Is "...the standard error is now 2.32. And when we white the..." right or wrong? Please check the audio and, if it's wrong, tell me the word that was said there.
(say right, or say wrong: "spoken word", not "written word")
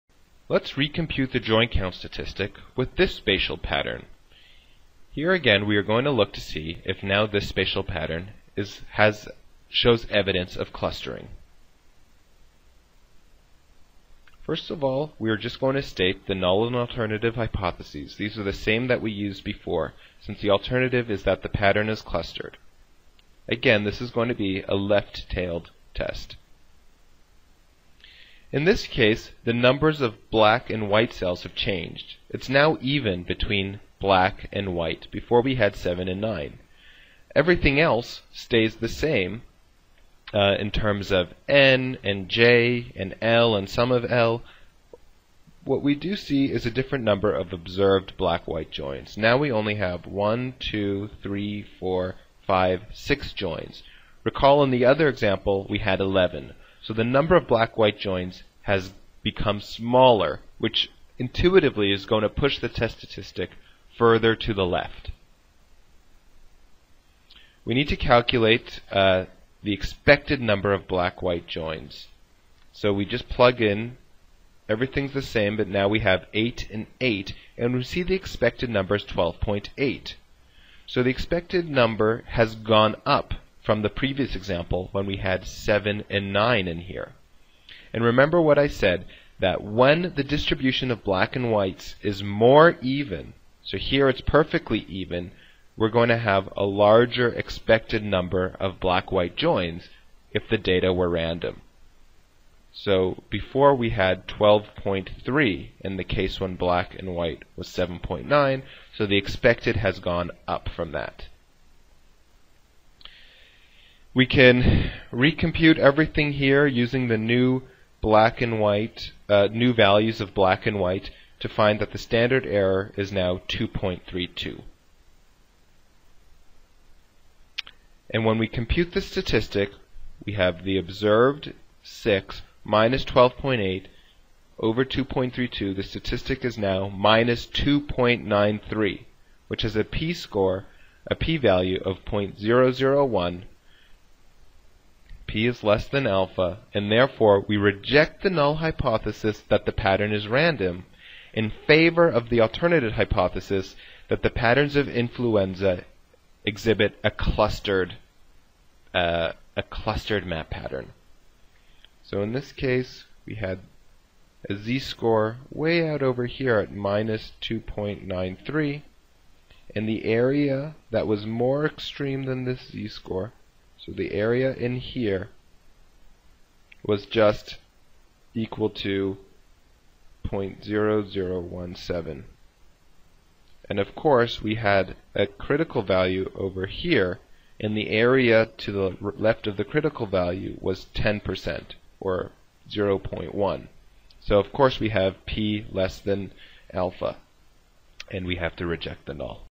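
wrong: "compute", not "white".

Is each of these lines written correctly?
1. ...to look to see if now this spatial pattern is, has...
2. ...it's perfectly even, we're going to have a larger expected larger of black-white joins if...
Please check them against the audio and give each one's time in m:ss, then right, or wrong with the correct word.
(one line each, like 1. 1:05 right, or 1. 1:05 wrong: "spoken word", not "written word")
1. 0:06 right
2. 1:34 wrong: "number", not "larger".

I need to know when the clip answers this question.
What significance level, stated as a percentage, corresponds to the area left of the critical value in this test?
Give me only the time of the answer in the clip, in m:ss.
3:10.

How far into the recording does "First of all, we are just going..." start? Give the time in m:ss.
0:14.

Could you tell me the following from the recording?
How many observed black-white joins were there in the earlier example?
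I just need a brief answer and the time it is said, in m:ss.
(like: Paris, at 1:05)
11, at 0:56.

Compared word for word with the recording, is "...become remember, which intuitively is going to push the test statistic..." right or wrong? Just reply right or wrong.
wrong.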